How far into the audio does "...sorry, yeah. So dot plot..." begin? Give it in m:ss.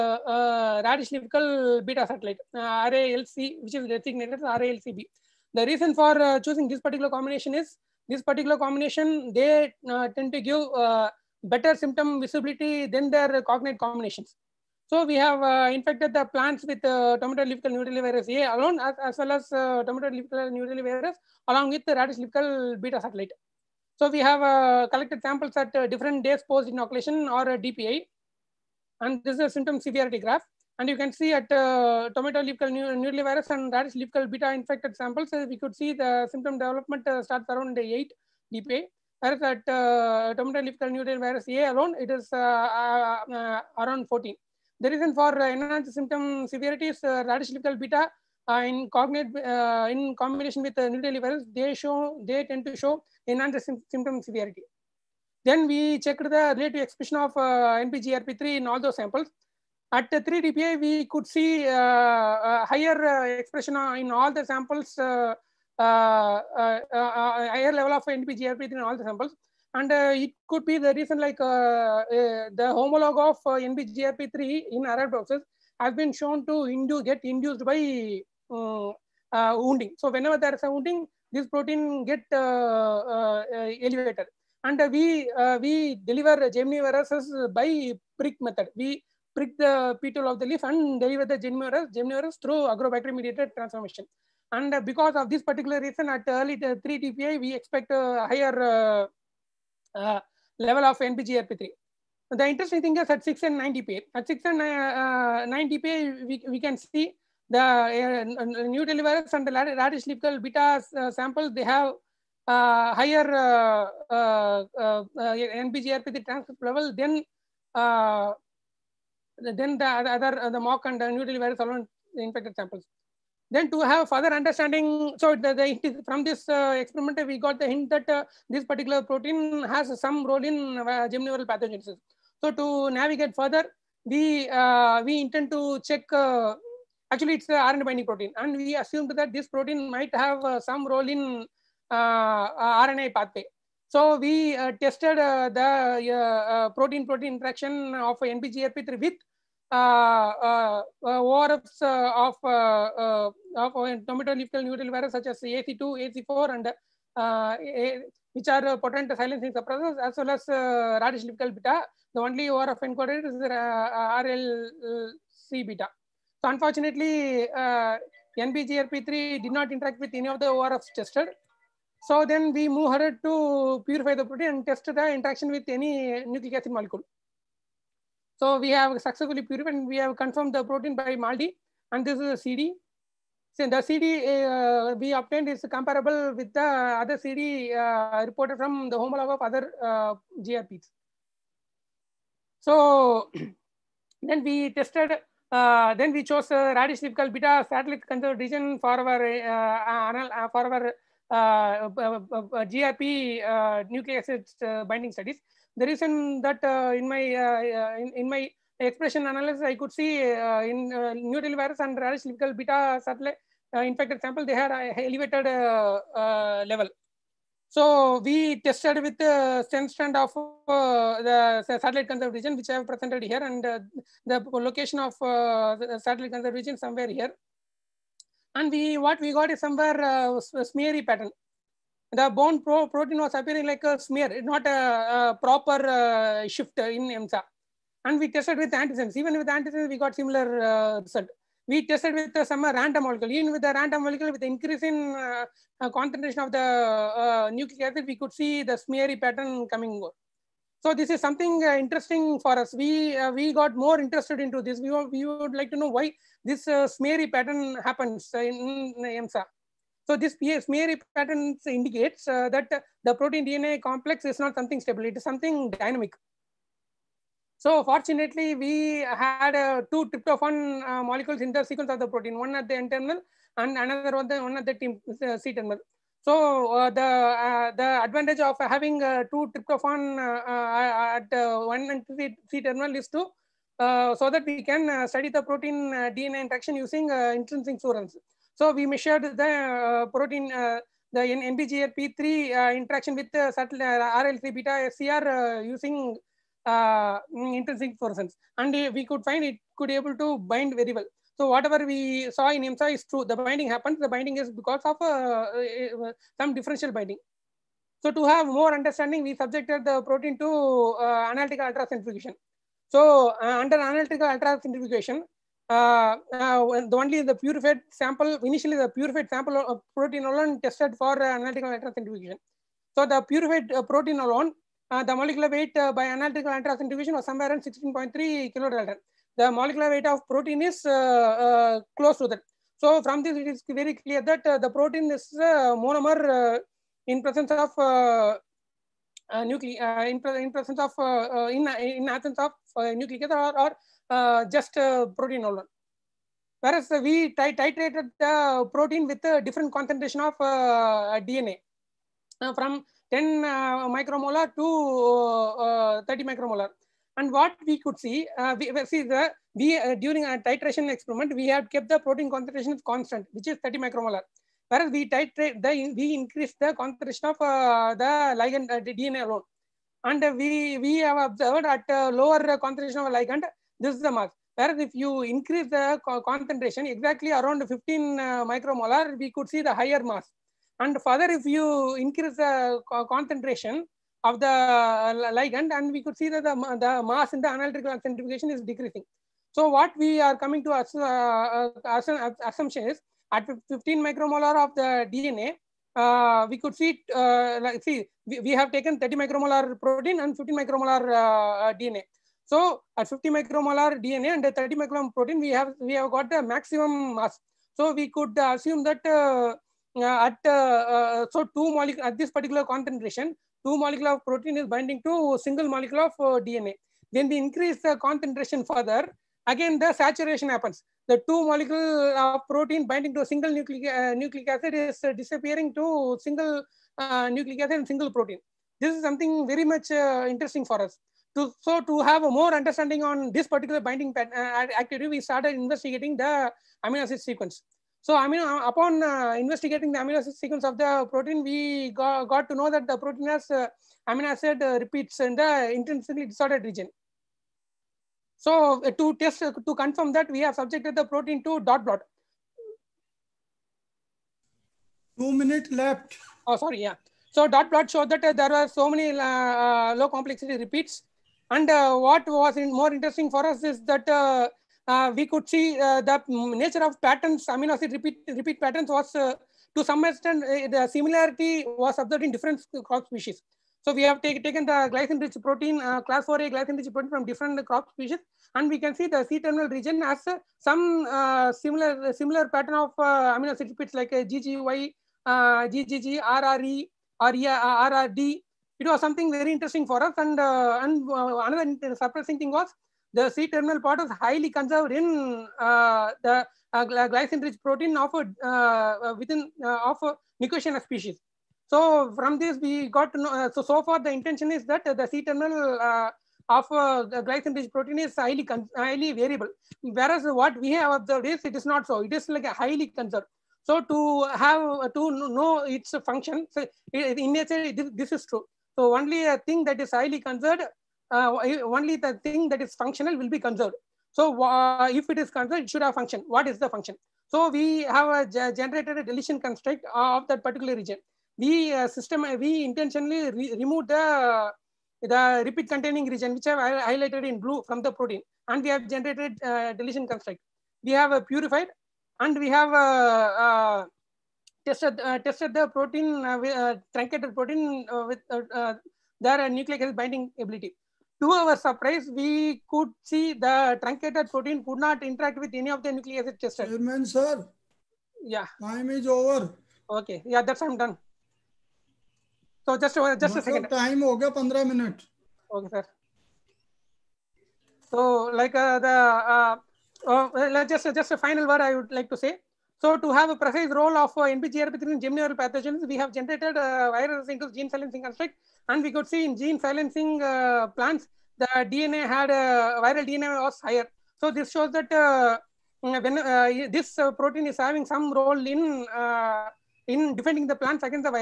7:36.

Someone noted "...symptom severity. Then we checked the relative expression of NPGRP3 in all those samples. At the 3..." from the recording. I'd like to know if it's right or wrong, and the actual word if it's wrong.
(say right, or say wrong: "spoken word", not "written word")
right.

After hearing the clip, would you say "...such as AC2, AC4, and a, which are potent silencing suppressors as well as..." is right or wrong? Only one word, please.
right.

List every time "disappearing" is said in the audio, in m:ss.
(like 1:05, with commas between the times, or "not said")
7:05.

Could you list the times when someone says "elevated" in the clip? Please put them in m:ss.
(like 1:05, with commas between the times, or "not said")
1:22, 3:35.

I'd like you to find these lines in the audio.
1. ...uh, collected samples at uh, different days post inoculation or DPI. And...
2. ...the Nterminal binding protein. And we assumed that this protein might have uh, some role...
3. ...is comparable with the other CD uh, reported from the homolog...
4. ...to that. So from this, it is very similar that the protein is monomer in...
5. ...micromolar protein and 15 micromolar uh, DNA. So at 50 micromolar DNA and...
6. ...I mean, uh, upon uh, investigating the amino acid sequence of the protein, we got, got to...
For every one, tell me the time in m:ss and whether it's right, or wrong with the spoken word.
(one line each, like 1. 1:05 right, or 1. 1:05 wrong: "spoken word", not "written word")
1. 0:24 right
2. 2:17 wrong: "RNA", not "Nterminal"
3. 3:05 right
4. 5:32 wrong: "clear", not "similar"
5. 6:39 right
6. 7:18 right.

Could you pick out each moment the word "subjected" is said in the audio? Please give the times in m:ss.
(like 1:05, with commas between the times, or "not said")
5:09, 7:30.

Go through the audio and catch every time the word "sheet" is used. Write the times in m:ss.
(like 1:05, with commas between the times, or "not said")
not said.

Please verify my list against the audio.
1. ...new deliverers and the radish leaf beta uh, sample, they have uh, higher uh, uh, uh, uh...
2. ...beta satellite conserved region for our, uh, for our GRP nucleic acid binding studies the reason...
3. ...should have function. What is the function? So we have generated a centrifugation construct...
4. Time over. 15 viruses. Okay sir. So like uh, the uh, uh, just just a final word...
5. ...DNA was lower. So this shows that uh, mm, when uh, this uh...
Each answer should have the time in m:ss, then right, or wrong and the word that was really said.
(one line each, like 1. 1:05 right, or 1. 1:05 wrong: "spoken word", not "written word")
1. 1:48 right
2. 3:17 right
3. 8:45 wrong: "deletion", not "centrifugation"
4. 9:23 wrong: "minutes", not "viruses"
5. 9:43 wrong: "higher", not "lower".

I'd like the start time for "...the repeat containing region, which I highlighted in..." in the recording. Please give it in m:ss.
8:55.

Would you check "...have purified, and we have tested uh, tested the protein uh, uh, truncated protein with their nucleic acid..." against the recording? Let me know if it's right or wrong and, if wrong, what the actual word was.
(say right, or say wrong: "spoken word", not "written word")
right.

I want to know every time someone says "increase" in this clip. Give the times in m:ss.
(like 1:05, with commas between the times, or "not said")
4:04, 6:06, 6:15, 6:21, 6:57.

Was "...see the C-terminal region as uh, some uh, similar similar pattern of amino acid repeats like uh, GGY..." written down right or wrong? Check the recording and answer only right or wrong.
right.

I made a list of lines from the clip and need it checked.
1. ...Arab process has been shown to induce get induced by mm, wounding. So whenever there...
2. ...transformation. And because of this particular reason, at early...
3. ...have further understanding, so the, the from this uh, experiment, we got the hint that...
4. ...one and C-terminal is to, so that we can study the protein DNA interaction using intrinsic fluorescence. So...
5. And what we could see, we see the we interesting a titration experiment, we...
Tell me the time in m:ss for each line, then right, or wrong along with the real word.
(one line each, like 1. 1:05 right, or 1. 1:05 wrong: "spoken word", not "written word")
1. 1:14 right
2. 1:33 right
3. 2:03 right
4. 4:41 right
5. 5:57 wrong: "during", not "interesting".